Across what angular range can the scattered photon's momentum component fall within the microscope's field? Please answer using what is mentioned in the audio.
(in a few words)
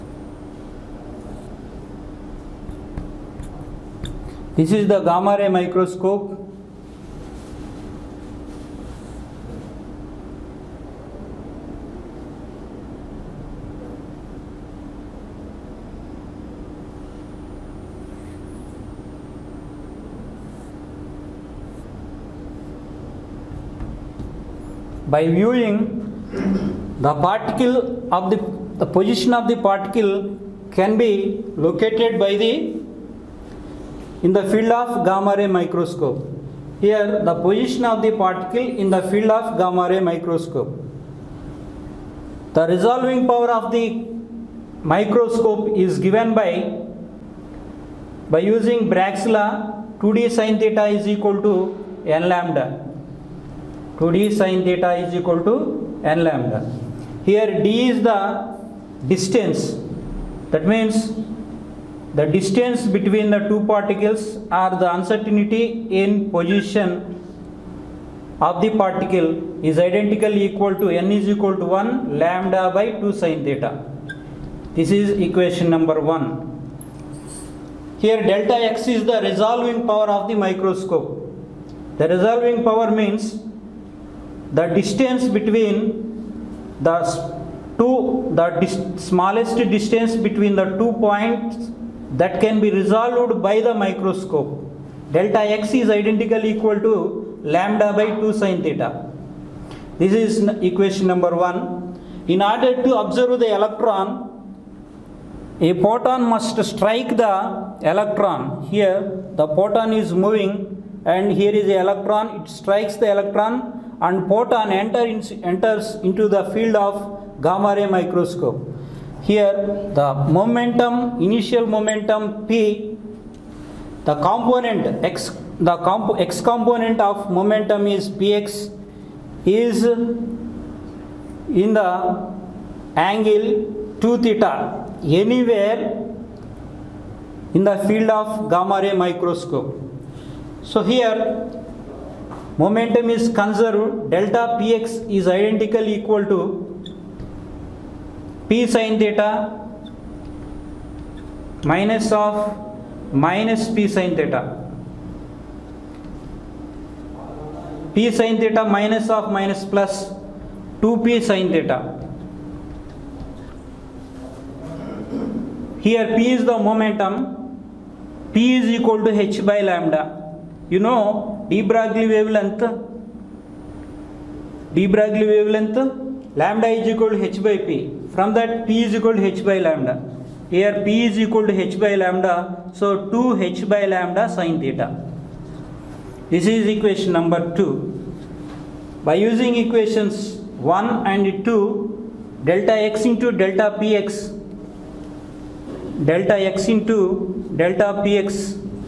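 2 theta.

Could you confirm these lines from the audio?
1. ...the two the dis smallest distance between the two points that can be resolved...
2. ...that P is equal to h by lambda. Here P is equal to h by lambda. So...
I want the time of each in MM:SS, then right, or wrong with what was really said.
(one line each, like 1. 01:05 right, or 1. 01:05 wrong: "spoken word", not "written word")
1. 01:26 right
2. 02:58 right.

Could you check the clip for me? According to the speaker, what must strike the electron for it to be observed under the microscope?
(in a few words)
a photon.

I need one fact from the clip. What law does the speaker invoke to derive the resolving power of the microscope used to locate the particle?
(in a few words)
Bragg's law.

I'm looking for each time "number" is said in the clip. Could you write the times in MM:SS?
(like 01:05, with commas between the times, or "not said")
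01:15, 01:41, 03:07.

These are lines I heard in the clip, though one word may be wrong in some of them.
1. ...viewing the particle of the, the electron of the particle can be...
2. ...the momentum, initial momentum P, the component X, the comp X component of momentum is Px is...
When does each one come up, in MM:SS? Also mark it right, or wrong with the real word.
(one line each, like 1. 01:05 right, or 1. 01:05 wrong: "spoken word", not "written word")
1. 00:25 wrong: "position", not "electron"
2. 01:59 right.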